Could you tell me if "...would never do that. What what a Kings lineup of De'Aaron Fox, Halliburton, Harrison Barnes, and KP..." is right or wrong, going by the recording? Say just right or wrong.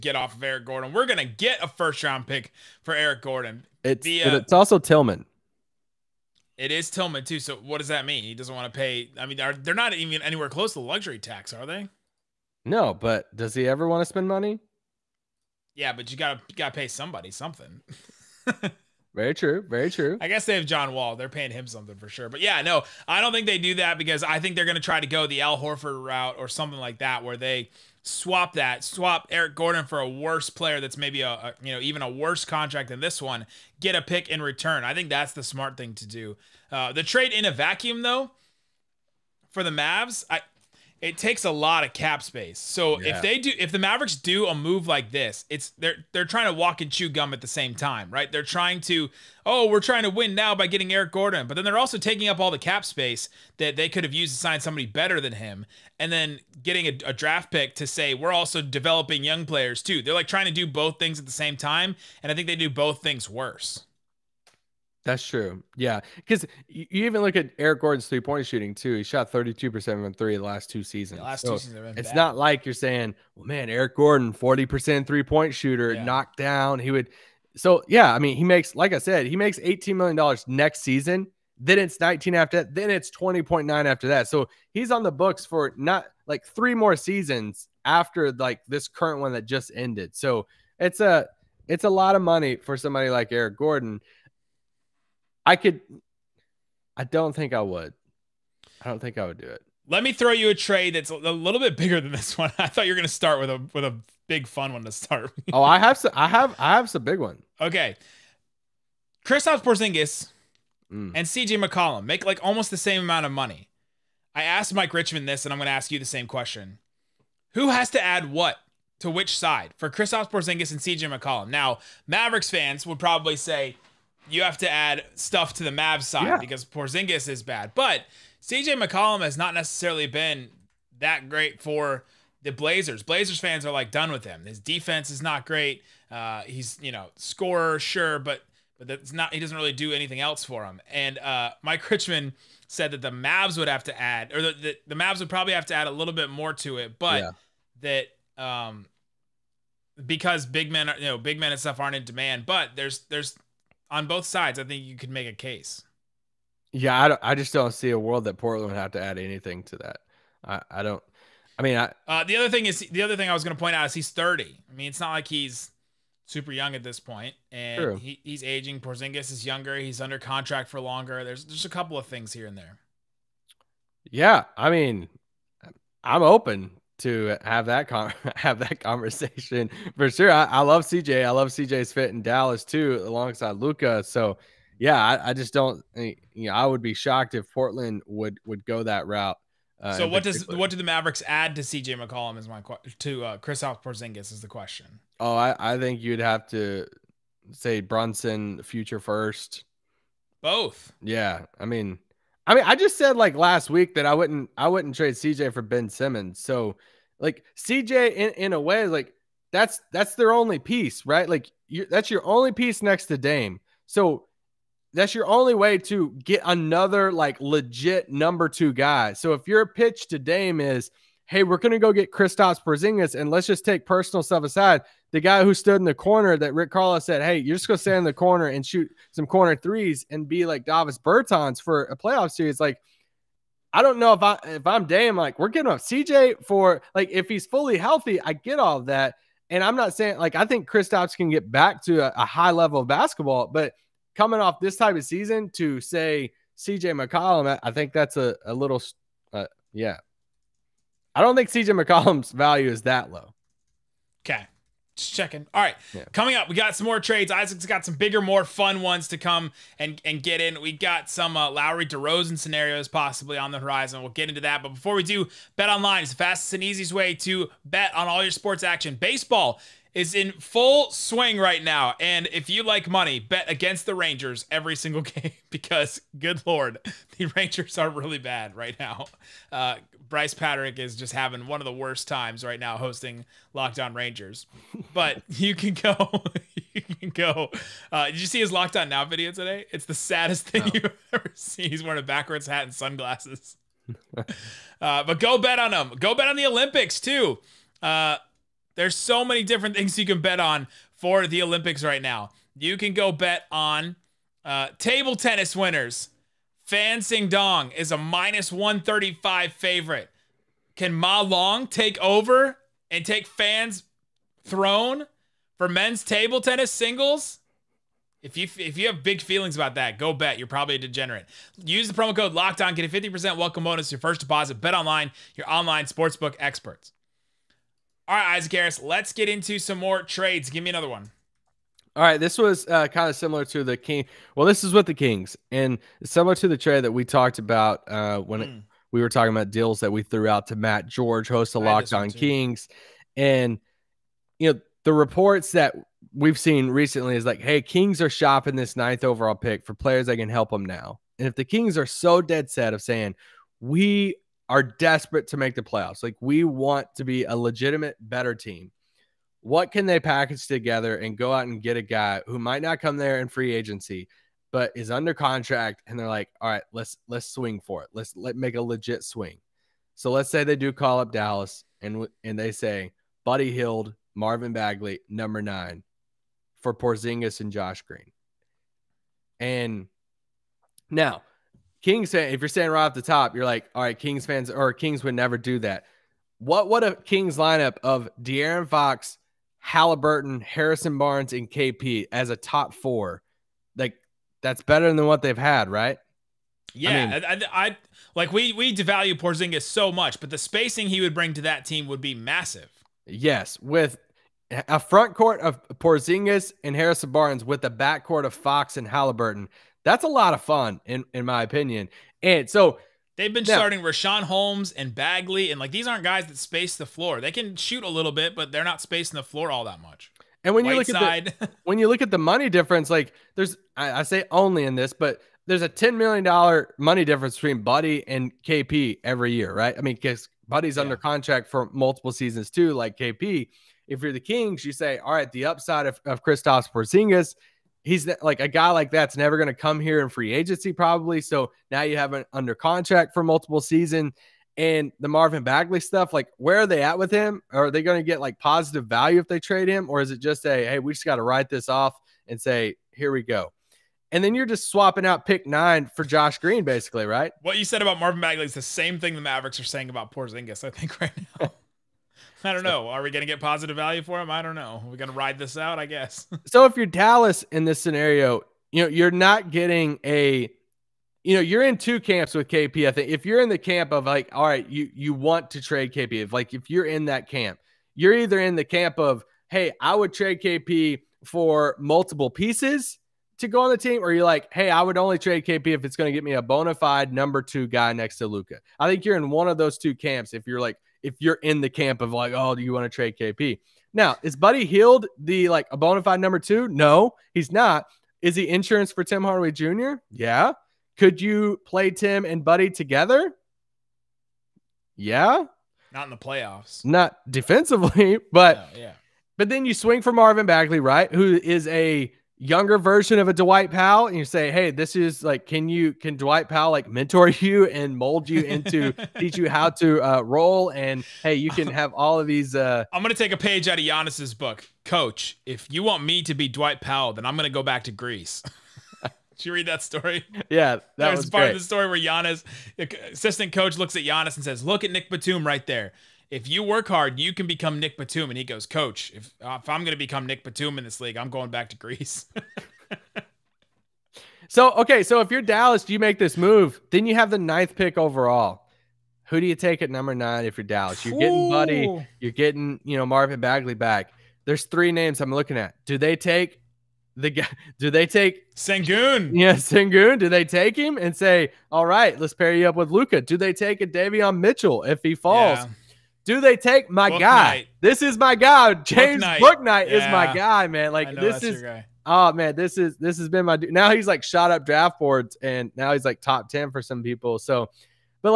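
right.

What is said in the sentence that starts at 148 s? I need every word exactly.
that um, because big men, are, you know, big men and stuff aren't in demand.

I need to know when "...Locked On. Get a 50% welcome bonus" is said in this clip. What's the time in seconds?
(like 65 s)
322 s.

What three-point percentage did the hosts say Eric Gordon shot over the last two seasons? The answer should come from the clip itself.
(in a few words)
32%.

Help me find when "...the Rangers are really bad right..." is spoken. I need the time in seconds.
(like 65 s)
277 s.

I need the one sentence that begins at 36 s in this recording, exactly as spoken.
Uh, the trade in a vacuum though for the Mavs, I it takes a lot of cap space.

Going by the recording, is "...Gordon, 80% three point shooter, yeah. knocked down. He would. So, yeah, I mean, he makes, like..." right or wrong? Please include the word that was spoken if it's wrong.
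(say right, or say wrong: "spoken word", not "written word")
wrong: "40", not "80".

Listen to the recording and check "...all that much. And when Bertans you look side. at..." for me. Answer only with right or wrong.
wrong.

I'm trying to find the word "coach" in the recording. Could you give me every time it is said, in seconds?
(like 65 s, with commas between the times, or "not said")
524 s, 533 s, 538 s.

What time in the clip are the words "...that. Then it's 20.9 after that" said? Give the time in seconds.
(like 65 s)
82 s.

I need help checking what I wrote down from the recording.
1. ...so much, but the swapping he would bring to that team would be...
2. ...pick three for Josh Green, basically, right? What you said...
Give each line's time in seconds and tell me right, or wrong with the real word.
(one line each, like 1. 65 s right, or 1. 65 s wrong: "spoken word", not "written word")
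1. 399 s wrong: "spacing", not "swapping"
2. 455 s wrong: "nine", not "three".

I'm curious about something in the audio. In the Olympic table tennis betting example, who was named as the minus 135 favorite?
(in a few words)
Fan Zhendong.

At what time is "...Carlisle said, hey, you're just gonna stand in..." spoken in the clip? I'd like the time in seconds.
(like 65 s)
226 s.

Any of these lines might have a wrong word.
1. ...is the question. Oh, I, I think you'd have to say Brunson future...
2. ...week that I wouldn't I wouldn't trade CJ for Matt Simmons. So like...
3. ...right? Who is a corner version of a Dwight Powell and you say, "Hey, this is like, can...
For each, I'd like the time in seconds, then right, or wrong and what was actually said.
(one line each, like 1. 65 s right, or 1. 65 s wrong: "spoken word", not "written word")
1. 194 s right
2. 203 s wrong: "Ben", not "Matt"
3. 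510 s wrong: "younger", not "corner".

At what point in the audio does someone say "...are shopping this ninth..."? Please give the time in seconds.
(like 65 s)
347 s.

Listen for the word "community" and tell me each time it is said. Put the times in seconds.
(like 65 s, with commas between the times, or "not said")
not said.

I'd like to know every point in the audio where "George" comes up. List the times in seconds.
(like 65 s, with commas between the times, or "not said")
340 s.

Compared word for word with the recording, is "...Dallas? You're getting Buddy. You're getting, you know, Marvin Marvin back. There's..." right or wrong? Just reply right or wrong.
wrong.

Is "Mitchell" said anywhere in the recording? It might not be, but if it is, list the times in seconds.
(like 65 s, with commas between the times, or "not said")
564 s.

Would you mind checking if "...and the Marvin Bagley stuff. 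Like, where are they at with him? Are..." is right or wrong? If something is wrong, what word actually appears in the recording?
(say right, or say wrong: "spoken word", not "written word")
right.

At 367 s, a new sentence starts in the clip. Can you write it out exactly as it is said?
Let's let make a legit swing.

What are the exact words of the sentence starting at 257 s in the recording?
Isaac's got some bigger, more fun ones to come and, and get in.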